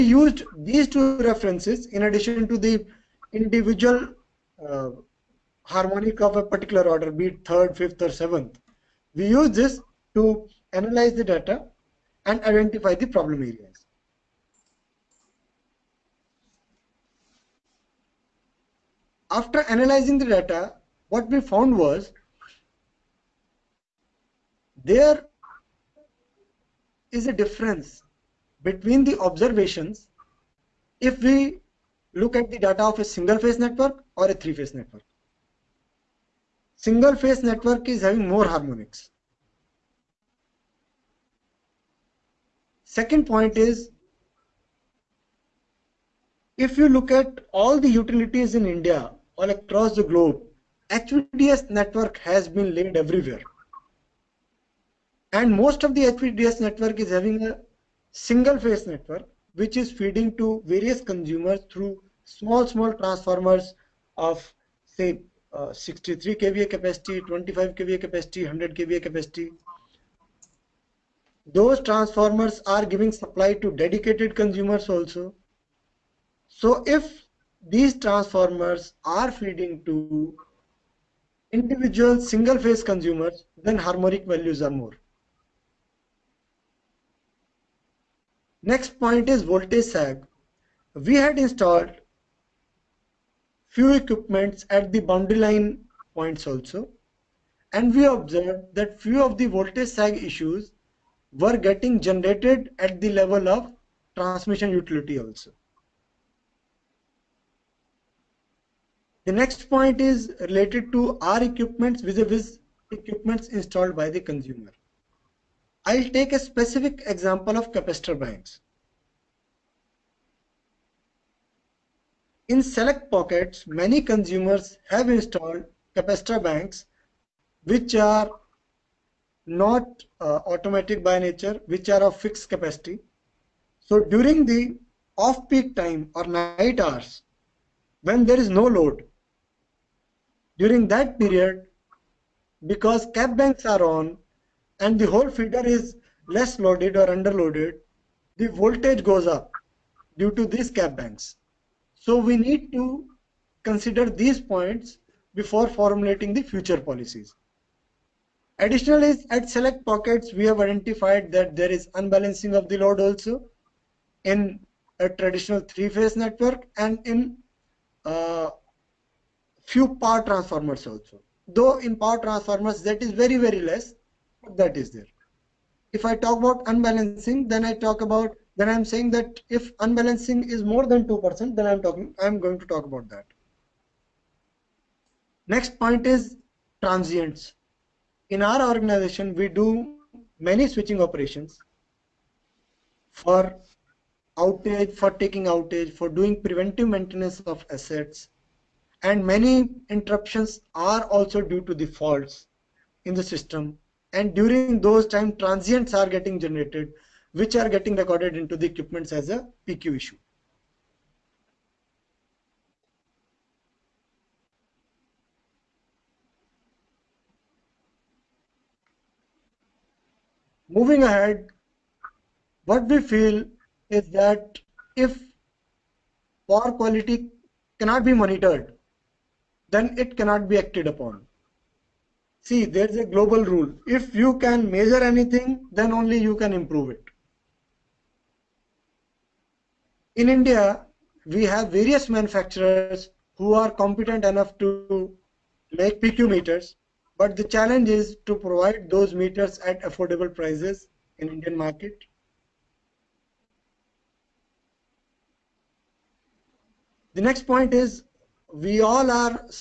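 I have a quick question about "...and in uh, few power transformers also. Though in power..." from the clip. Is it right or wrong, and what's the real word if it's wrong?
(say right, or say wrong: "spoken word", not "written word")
right.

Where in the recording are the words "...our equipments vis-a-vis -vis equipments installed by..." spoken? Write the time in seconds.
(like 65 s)
111 s.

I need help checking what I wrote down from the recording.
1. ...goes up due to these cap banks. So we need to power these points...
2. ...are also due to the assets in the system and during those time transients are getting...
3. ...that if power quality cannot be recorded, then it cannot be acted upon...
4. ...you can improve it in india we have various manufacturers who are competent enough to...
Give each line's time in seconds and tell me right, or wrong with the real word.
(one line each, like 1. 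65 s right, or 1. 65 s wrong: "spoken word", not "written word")
1. 149 s wrong: "consider", not "power"
2. 200 s wrong: "faults", not "assets"
3. 224 s wrong: "monitored", not "recorded"
4. 236 s right.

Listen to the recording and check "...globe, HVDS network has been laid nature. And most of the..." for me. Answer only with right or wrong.
wrong.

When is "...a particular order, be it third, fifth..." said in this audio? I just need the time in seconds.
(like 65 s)
6 s.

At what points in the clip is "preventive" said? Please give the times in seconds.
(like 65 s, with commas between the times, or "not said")
196 s.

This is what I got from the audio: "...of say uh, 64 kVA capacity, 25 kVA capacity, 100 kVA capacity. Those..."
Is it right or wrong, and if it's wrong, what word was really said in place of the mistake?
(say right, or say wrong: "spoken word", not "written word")
wrong: "63", not "64".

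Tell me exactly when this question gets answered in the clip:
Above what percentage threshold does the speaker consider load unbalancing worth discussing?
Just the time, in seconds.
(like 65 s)
181 s.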